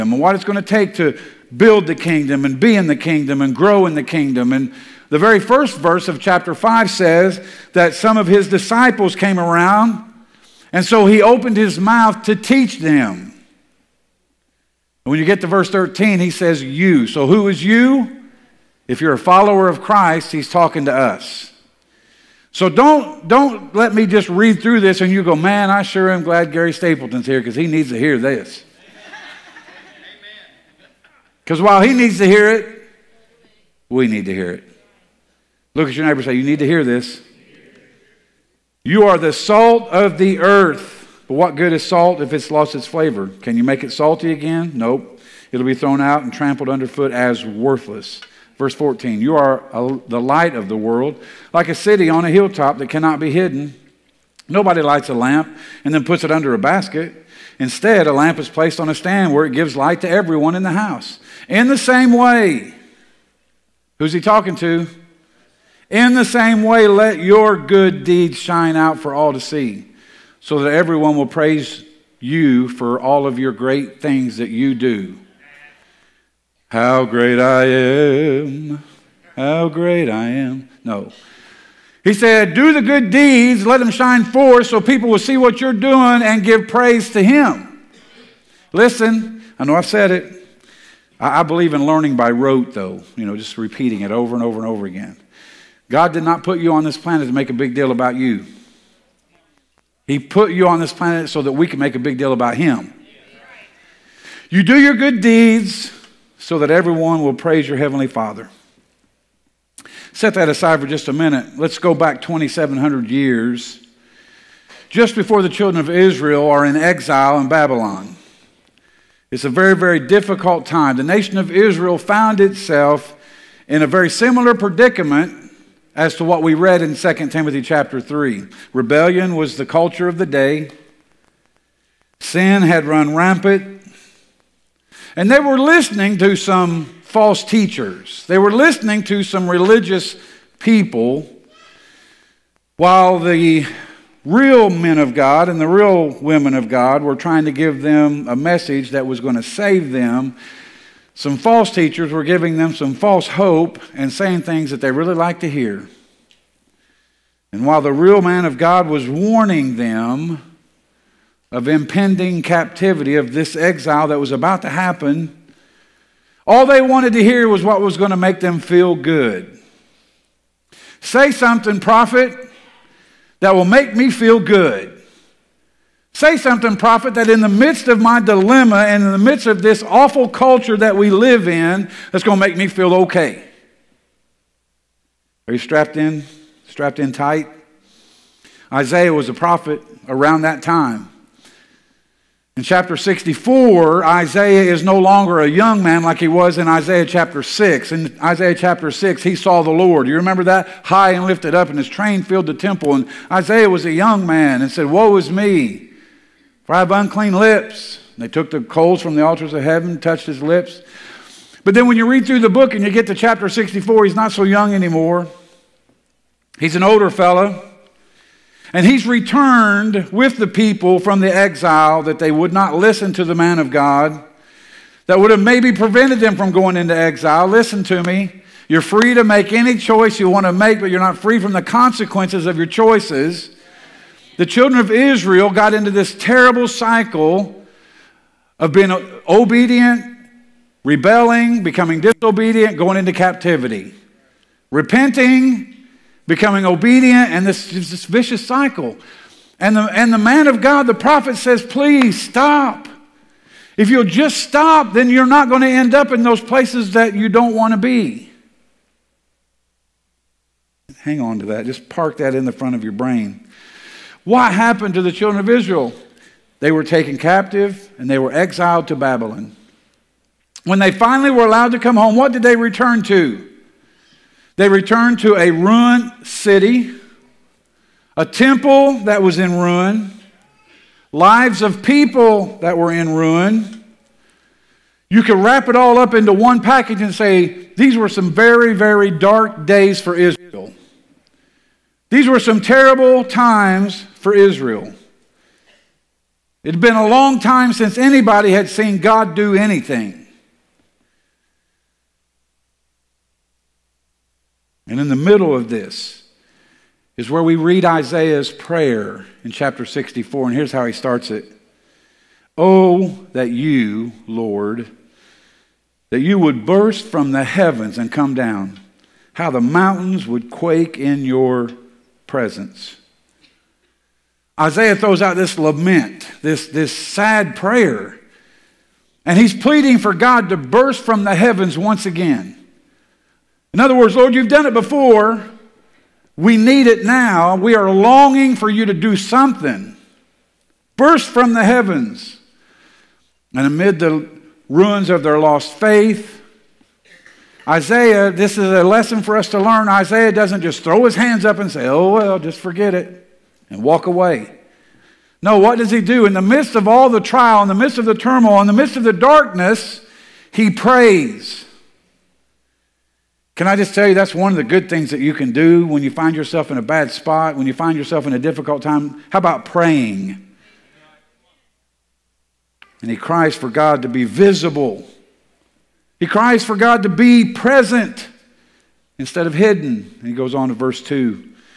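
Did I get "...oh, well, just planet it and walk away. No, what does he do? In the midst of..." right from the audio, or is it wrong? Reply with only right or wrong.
wrong.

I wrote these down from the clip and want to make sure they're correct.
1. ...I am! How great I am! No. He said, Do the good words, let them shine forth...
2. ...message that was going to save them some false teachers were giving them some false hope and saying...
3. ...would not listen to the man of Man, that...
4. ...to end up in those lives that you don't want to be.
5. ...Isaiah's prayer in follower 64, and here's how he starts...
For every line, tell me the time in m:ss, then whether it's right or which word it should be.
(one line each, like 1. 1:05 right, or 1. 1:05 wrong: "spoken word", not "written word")
1. 1:17 wrong: "deeds", not "words"
2. 2:28 right
3. 3:42 wrong: "God", not "Man"
4. 4:15 wrong: "places", not "lives"
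5. 5:07 wrong: "chapter", not "follower".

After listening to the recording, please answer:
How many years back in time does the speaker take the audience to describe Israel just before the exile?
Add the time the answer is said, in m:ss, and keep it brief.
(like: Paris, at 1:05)
2,700, at 1:52.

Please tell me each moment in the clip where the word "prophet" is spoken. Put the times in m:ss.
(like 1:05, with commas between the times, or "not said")
2:51, 2:56, 3:09, 4:10.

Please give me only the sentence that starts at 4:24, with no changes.
What happened to the children of Israel?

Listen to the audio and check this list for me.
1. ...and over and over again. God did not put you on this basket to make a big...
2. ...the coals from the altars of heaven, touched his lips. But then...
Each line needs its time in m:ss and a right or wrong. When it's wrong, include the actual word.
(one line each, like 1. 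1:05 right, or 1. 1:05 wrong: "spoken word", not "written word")
1. 1:34 wrong: "planet", not "basket"
2. 3:28 right.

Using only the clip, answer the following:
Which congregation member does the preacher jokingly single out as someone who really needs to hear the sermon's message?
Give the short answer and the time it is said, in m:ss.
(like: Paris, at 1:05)
Gary Stapleton, at 0:26.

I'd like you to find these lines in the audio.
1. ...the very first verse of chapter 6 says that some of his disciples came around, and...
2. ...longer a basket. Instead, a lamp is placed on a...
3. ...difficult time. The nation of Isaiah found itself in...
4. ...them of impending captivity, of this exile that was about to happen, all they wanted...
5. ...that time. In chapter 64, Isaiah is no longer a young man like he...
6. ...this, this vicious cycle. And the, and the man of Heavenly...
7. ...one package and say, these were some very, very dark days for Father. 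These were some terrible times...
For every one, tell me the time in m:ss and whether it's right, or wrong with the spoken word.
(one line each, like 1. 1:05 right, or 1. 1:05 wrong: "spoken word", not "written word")
1. 0:05 wrong: "5", not "6"
2. 0:56 wrong: "under", not "longer"
3. 2:00 wrong: "Israel", not "Isaiah"
4. 2:39 right
5. 3:10 right
6. 4:07 wrong: "God", not "Heavenly"
7. 4:46 wrong: "Israel", not "Father".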